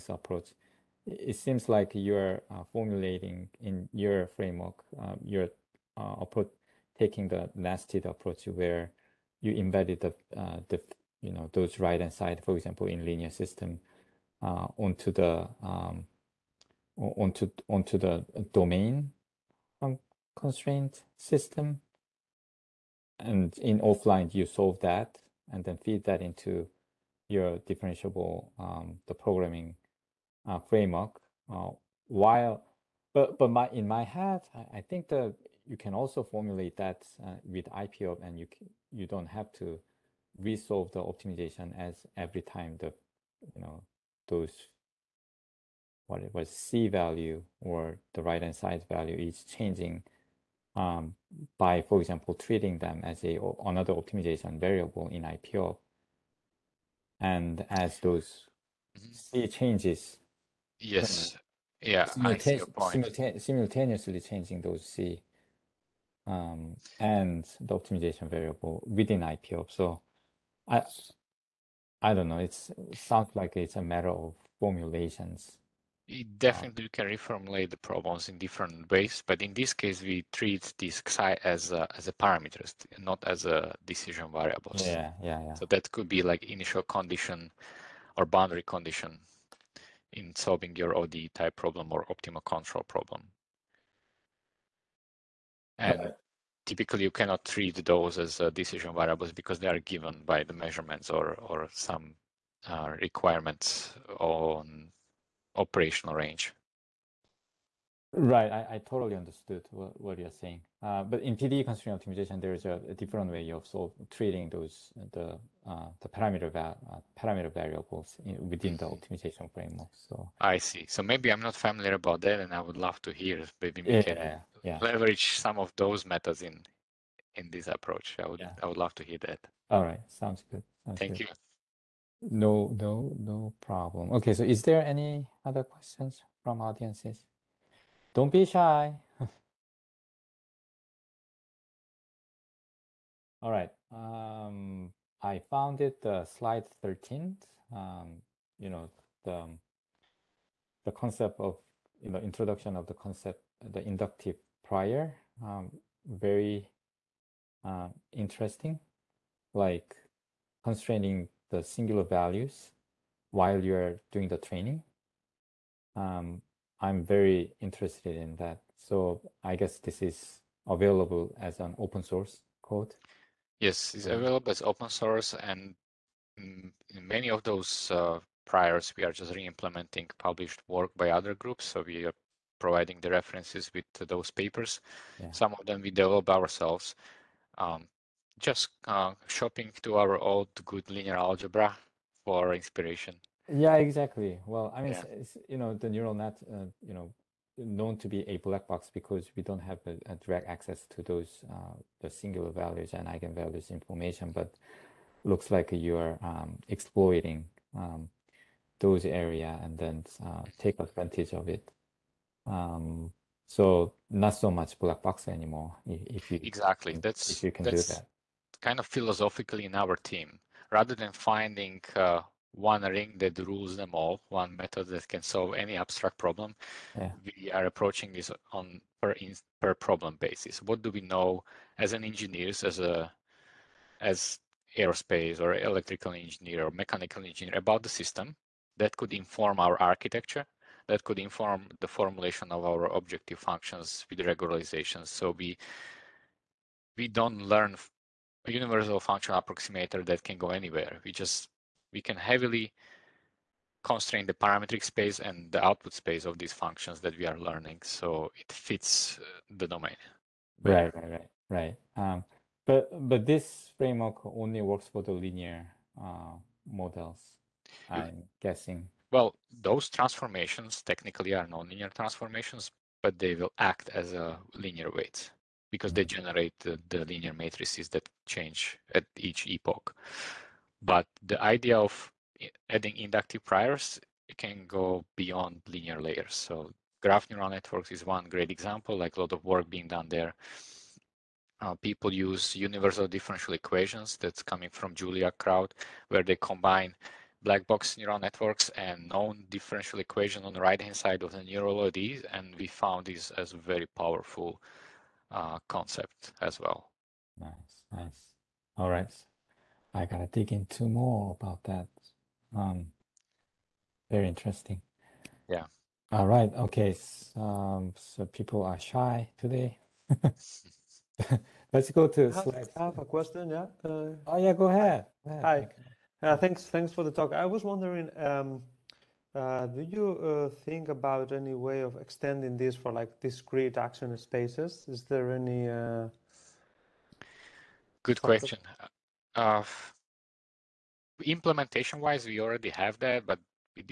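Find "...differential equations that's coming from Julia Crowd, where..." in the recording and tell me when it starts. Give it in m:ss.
4:53.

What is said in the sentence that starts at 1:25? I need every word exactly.
So that could be like initial condition or boundary condition in solving your ODE type problem or optimal control problem.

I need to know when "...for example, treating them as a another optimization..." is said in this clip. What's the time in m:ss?
0:51.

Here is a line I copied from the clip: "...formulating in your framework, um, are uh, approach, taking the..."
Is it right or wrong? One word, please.
right.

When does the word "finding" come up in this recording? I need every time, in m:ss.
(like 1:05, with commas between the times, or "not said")
3:41.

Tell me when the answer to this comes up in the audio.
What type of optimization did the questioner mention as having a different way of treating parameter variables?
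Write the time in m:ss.
1:51.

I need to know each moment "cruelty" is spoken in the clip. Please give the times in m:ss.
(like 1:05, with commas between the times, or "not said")
not said.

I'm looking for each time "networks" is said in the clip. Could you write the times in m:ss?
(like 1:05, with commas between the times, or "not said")
4:47, 4:58.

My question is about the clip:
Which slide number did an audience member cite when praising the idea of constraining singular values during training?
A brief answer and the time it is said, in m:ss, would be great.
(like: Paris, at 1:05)
13, at 2:26.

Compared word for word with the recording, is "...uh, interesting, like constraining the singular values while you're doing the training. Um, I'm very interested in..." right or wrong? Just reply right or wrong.
right.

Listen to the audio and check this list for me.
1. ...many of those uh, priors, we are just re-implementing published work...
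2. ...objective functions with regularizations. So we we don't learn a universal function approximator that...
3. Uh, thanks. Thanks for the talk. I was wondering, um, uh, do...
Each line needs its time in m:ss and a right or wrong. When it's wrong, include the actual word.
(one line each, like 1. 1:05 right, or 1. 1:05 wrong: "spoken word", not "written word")
1. 2:57 right
2. 4:02 right
3. 5:26 right.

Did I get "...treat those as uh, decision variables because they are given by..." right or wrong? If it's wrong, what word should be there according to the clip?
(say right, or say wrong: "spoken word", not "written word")
right.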